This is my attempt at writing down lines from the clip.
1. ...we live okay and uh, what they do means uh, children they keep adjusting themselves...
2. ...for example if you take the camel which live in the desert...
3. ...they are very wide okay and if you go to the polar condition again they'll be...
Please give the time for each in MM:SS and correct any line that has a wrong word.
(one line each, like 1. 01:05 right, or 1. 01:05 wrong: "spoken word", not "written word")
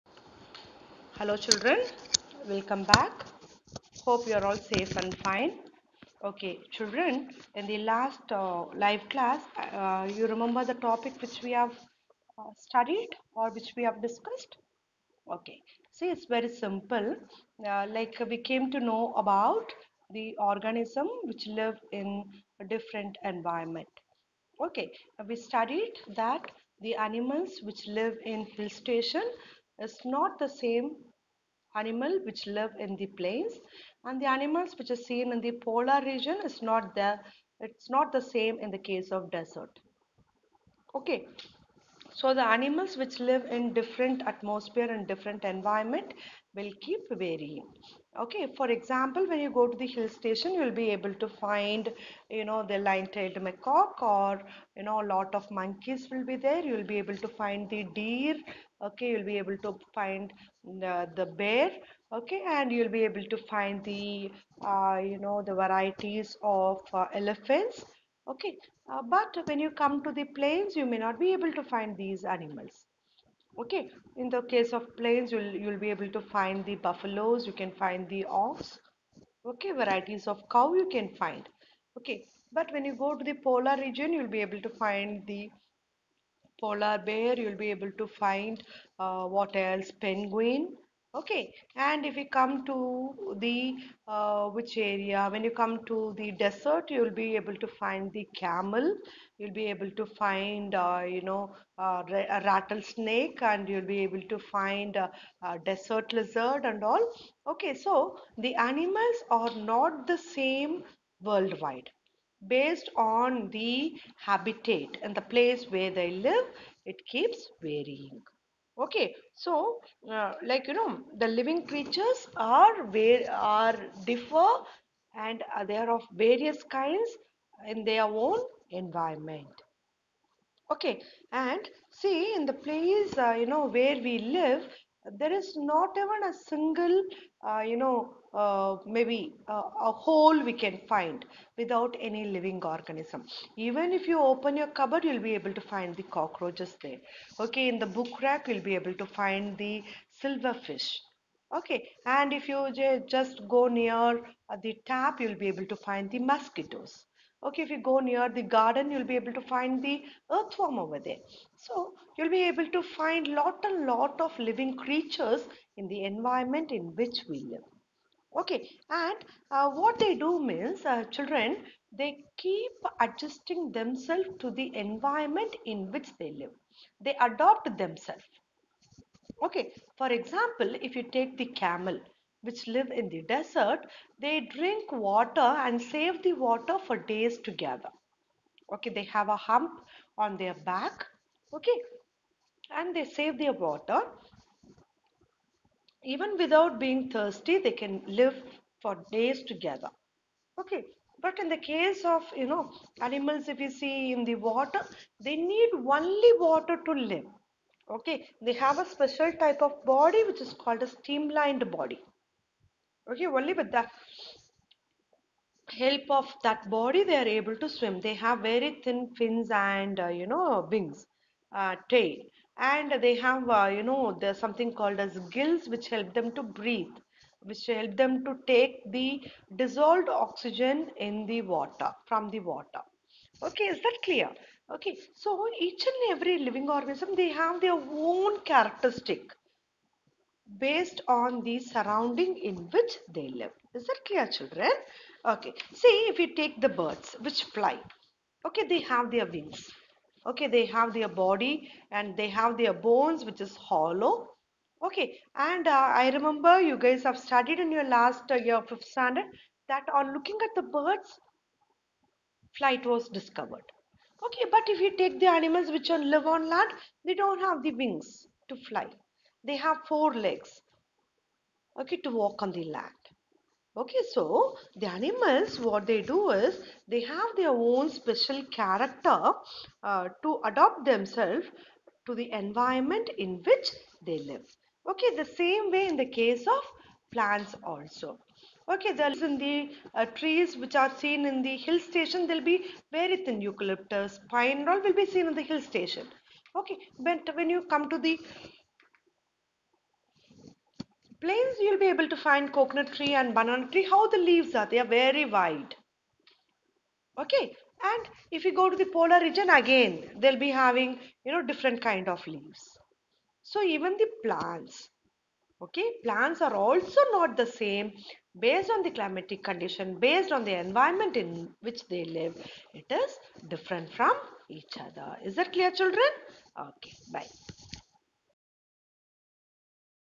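1. 02:47 right
2. 02:59 right
3. 05:04 wrong: "region", not "condition".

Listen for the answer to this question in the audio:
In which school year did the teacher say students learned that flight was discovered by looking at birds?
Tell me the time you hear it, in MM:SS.
04:18.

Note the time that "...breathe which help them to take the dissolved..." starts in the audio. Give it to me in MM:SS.
03:46.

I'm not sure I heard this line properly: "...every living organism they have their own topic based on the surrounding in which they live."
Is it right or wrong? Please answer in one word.
wrong.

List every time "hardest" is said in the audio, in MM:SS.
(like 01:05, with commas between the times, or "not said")
not said.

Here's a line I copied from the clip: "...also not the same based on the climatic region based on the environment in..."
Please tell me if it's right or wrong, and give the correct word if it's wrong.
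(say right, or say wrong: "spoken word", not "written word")
wrong: "condition", not "region".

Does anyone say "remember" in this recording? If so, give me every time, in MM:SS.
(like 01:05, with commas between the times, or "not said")
00:10, 04:16.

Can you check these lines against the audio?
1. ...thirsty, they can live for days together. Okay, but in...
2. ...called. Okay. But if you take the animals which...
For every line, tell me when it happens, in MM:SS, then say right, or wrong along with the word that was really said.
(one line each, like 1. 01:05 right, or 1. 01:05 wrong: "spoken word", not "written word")
1. 03:17 right
2. 04:23 wrong: "discovered", not "called".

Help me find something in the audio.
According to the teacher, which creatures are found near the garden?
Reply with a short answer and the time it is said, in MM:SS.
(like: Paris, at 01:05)
Earthworm, at 02:40.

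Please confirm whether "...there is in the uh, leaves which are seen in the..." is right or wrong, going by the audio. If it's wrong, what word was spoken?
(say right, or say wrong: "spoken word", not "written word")
wrong: "trees", not "leaves".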